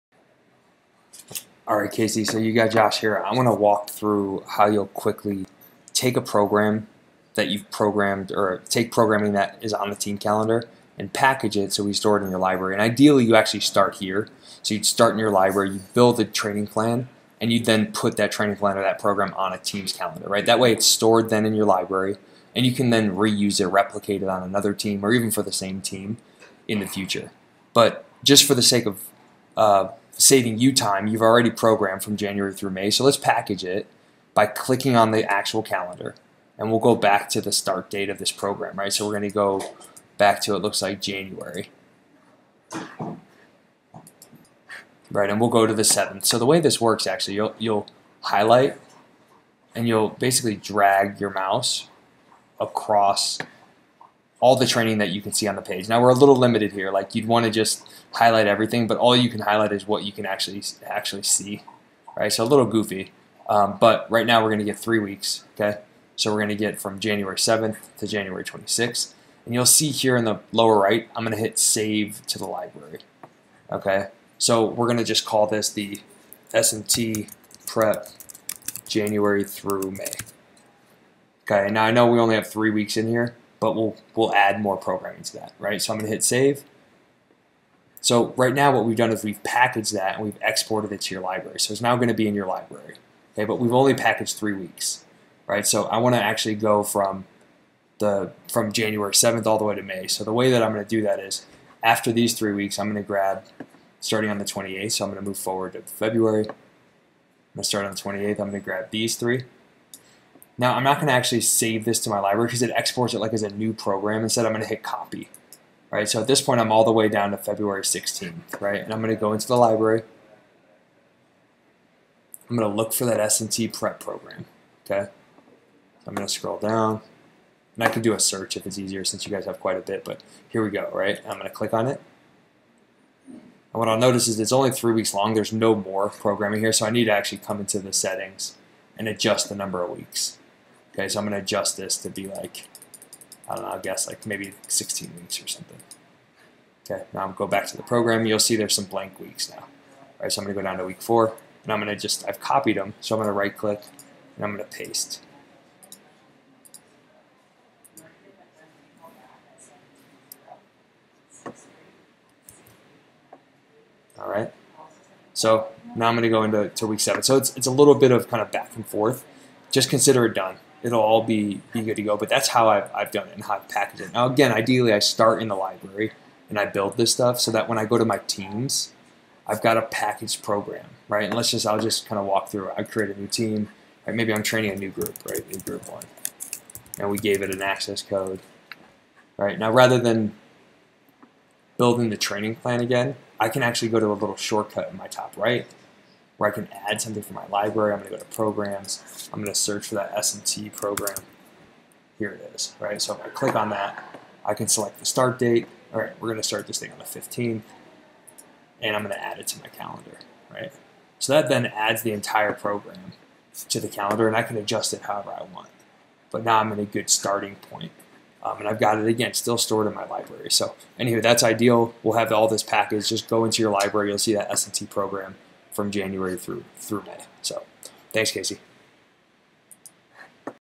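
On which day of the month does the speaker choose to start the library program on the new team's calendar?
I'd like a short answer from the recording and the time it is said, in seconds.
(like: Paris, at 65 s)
15th, at 206 s.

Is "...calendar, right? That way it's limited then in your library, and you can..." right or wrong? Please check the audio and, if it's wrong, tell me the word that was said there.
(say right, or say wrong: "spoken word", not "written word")
wrong: "stored", not "limited".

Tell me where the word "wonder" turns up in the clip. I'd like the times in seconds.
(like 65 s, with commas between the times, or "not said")
not said.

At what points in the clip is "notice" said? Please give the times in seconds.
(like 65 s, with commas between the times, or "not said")
133 s.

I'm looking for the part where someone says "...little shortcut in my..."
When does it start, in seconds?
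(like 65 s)
194 s.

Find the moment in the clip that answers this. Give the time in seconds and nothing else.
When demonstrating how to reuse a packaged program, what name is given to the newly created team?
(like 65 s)
185 s.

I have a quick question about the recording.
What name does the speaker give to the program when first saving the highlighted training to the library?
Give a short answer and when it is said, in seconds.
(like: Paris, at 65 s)
SMT prep January through May, at 76 s.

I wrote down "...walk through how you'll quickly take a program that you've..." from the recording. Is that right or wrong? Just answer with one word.
right.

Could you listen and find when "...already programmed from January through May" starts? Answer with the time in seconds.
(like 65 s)
31 s.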